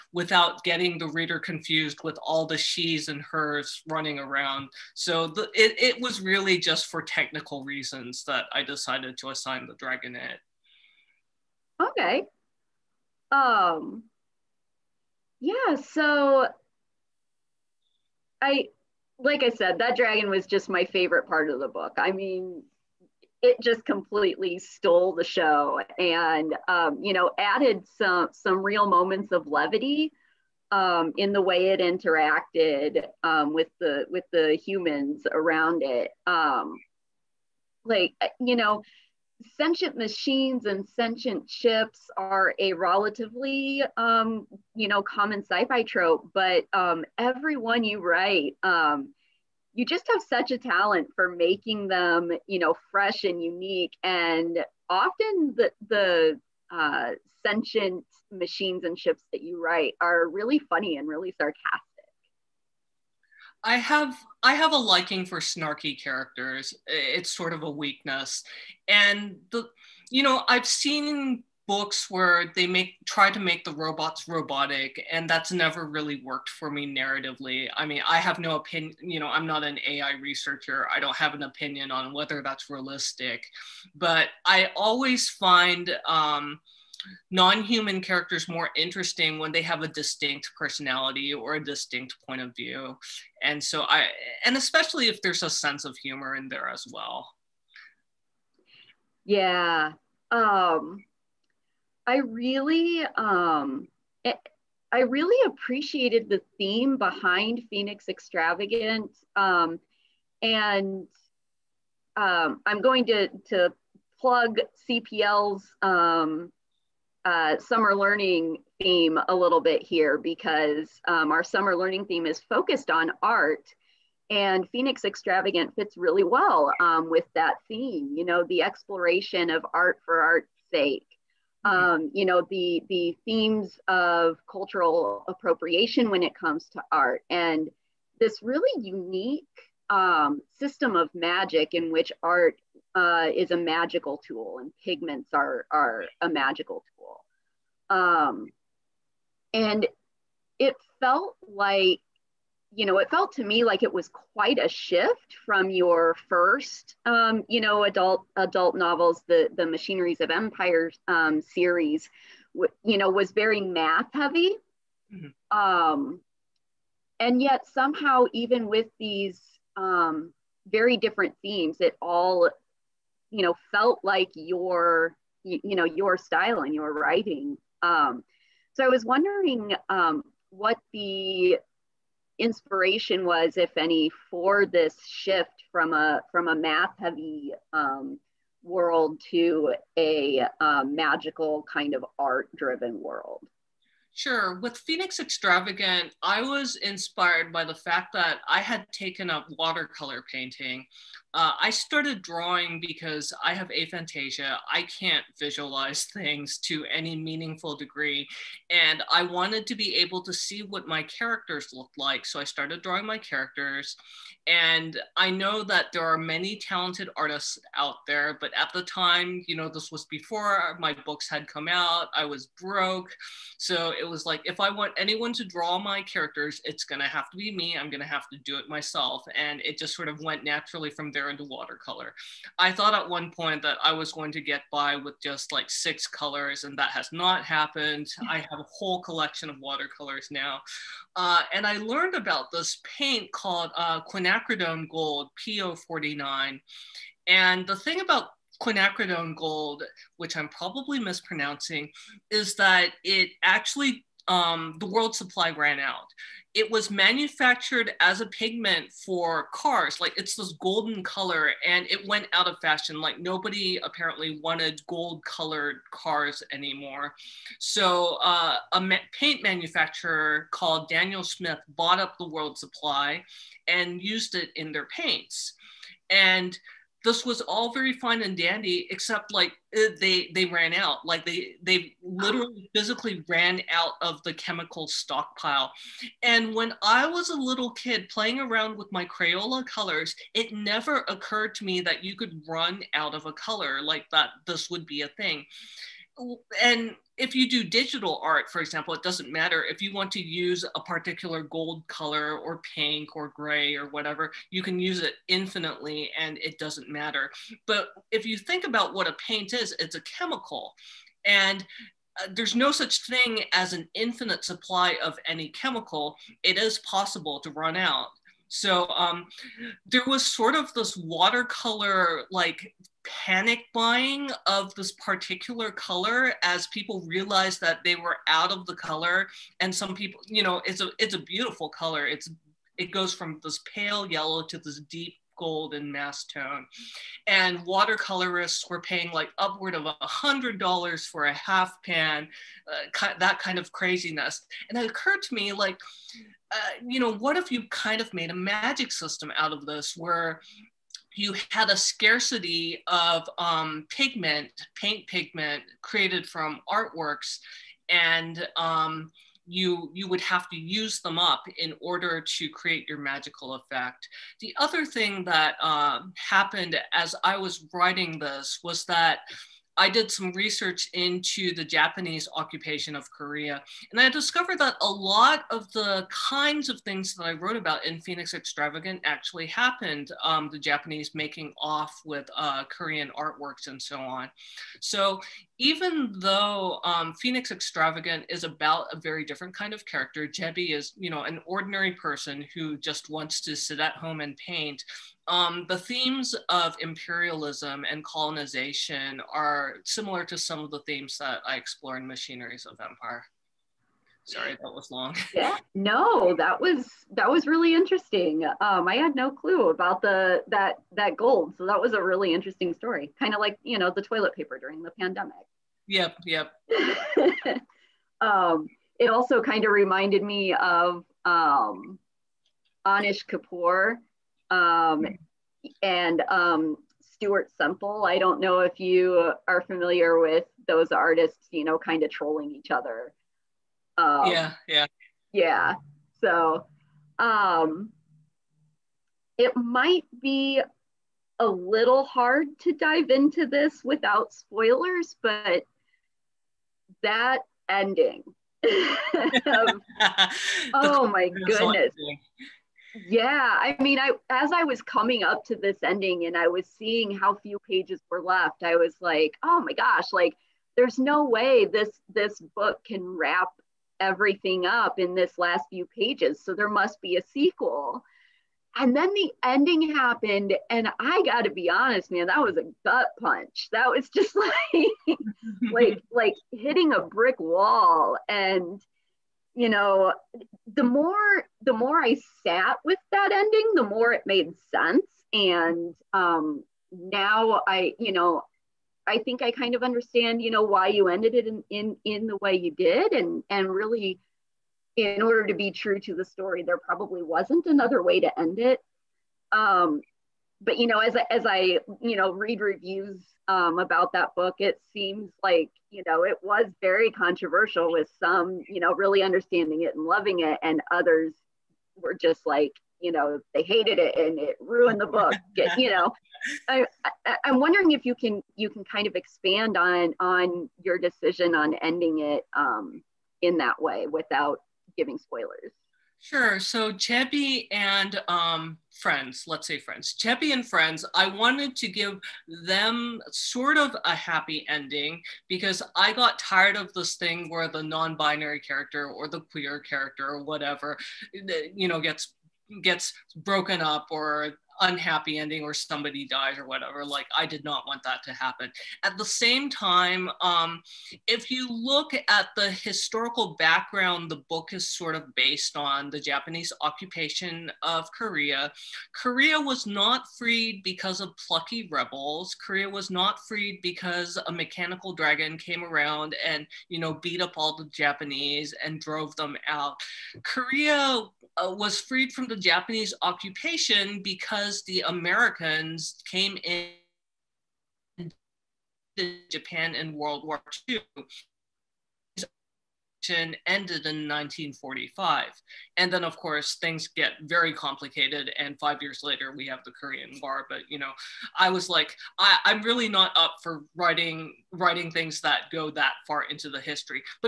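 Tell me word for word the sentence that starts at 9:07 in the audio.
Like, I did not want that to happen.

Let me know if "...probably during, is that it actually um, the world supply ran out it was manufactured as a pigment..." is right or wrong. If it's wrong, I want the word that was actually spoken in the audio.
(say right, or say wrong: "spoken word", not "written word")
wrong: "mispronouncing", not "during".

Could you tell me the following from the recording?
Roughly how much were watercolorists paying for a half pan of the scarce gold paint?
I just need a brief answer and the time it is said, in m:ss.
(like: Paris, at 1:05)
$100, at 5:39.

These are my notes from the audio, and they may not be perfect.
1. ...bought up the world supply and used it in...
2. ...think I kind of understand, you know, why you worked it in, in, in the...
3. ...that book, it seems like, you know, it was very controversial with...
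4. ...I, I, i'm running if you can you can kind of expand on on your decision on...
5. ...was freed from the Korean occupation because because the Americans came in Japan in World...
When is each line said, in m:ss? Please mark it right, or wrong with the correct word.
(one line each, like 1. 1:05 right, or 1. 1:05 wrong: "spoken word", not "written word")
1. 4:31 right
2. 8:09 wrong: "ended", not "worked"
3. 8:24 right
4. 8:36 wrong: "wondering", not "running"
5. 9:31 wrong: "Japanese", not "Korean".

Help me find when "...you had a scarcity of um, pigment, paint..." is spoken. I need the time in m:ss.
5:51.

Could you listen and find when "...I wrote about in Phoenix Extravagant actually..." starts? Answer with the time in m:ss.
6:17.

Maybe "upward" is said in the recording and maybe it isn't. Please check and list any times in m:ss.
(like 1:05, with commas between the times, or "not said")
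5:39.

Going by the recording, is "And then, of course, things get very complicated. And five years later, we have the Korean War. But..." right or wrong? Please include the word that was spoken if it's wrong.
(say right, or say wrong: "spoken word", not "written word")
right.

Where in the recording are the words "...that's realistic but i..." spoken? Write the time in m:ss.
1:22.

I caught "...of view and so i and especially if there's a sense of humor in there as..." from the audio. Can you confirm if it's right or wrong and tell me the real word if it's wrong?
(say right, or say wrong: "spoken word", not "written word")
right.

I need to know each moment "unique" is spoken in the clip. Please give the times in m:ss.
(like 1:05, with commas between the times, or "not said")
0:53, 2:18.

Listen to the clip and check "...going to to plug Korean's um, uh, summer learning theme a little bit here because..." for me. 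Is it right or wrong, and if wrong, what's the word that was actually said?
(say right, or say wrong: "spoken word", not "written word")
wrong: "CPL", not "Korean".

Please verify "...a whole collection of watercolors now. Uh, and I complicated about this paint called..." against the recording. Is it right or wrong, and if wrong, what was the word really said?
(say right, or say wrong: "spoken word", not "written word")
wrong: "learned", not "complicated".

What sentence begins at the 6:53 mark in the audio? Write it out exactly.
Kind of like you know the toilet paper during the pandemic.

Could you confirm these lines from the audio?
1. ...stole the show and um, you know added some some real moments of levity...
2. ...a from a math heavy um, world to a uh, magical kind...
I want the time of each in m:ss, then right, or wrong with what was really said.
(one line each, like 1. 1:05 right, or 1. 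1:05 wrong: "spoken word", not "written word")
1. 0:24 right
2. 3:05 right.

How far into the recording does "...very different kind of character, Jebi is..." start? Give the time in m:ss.
6:28.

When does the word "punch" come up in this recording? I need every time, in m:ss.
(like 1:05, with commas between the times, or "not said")
7:53.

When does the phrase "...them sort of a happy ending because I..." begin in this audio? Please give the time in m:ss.
8:52.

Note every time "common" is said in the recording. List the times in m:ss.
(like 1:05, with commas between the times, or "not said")
0:45.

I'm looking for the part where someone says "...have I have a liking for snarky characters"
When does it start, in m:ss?
1:03.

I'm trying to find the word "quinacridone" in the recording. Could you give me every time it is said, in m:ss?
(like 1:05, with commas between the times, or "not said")
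4:04, 4:08.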